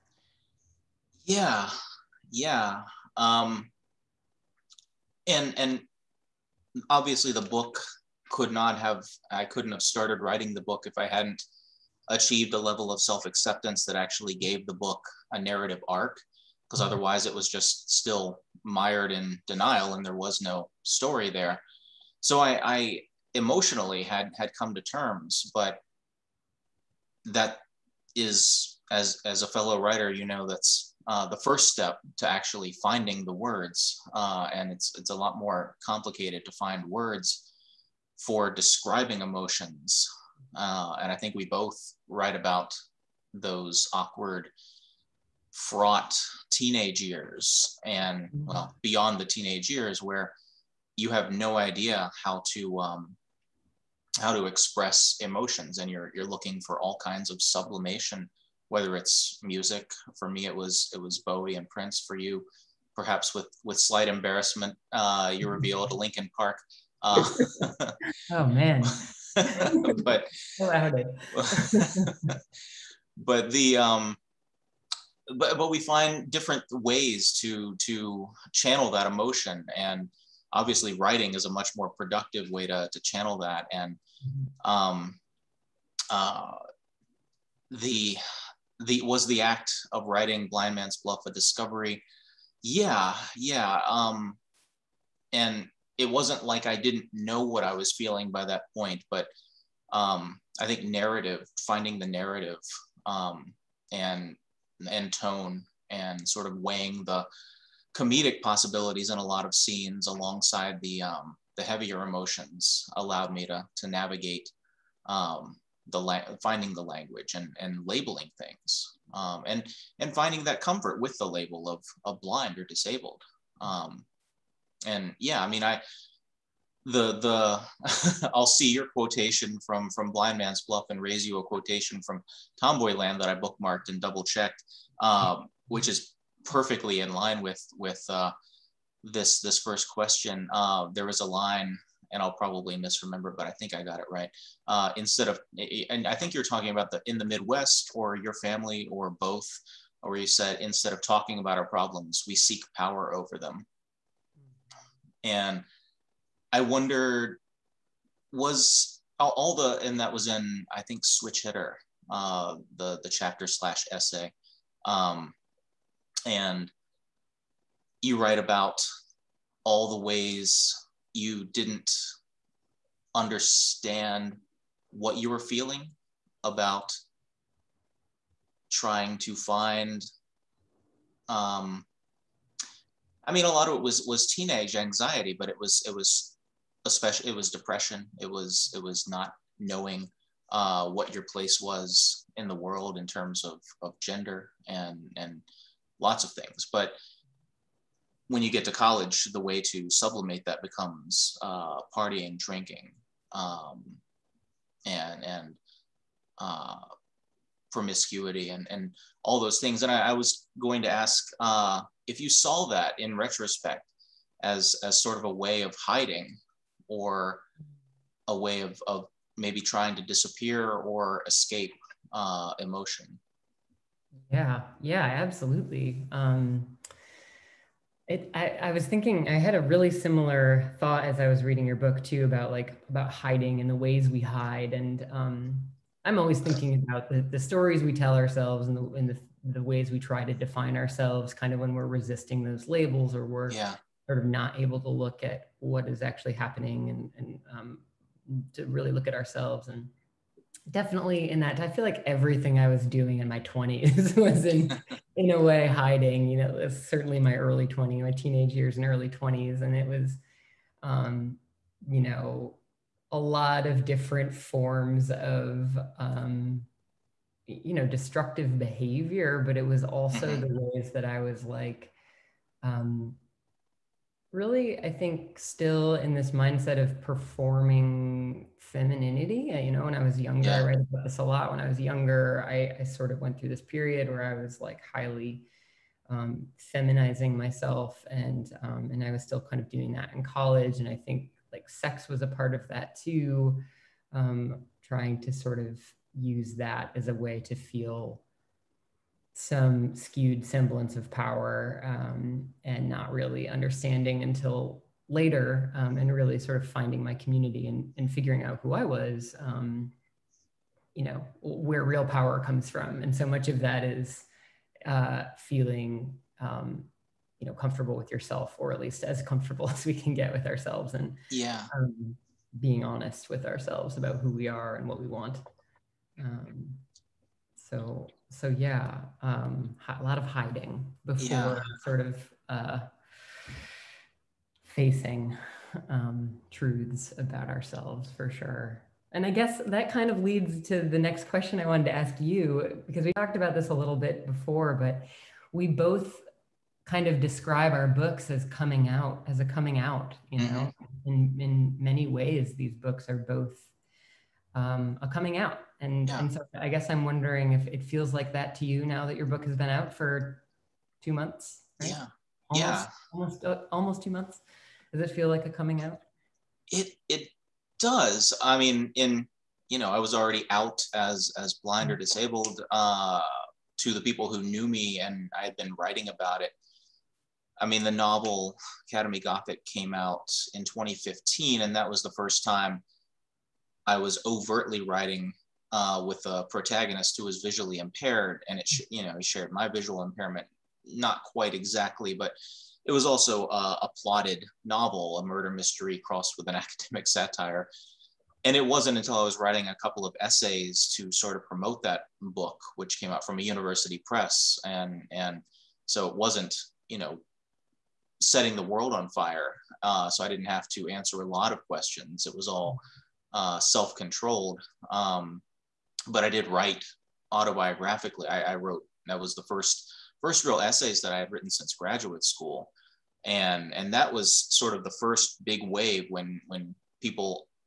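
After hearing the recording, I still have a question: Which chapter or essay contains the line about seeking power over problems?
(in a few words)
Switch Hitter.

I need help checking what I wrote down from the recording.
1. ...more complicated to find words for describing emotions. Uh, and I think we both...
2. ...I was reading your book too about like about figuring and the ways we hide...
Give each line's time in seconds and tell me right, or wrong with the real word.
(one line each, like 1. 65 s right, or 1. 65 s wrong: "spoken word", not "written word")
1. 35 s right
2. 231 s wrong: "hiding", not "figuring".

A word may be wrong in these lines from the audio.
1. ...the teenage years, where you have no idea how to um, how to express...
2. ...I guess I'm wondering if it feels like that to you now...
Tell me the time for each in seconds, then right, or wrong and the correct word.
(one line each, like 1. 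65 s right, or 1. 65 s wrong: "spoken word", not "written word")
1. 49 s right
2. 356 s right.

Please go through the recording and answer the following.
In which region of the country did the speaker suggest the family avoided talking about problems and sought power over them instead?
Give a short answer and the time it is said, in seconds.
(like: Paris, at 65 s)
The Midwest, at 147 s.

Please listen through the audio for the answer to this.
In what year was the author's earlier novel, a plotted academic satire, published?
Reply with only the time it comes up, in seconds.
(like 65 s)
380 s.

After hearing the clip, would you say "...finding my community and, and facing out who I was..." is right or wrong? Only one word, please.
wrong.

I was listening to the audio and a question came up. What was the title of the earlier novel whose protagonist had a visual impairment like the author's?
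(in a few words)
Academy Gothic.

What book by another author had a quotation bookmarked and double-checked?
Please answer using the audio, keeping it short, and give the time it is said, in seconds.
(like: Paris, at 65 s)
Tomboyland, at 132 s.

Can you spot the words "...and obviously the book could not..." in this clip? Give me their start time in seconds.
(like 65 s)
5 s.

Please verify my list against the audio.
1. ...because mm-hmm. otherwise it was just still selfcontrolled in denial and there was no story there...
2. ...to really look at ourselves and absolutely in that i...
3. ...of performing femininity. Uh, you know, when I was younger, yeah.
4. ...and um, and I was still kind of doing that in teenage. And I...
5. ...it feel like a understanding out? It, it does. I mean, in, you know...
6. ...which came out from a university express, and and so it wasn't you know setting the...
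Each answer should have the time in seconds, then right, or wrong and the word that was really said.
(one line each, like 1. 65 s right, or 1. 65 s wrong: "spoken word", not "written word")
1. 16 s wrong: "mired", not "selfcontrolled"
2. 248 s wrong: "definitely", not "absolutely"
3. 276 s right
4. 288 s wrong: "college", not "teenage"
5. 365 s wrong: "coming", not "understanding"
6. 402 s wrong: "press", not "express".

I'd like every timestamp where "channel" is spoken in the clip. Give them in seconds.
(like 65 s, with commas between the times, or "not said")
78 s, 83 s.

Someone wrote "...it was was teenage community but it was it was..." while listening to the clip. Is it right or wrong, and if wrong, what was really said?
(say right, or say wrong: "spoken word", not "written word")
wrong: "anxiety", not "community".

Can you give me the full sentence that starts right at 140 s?
Uh, there was a line, and I'll probably misremember, but I think I got it right.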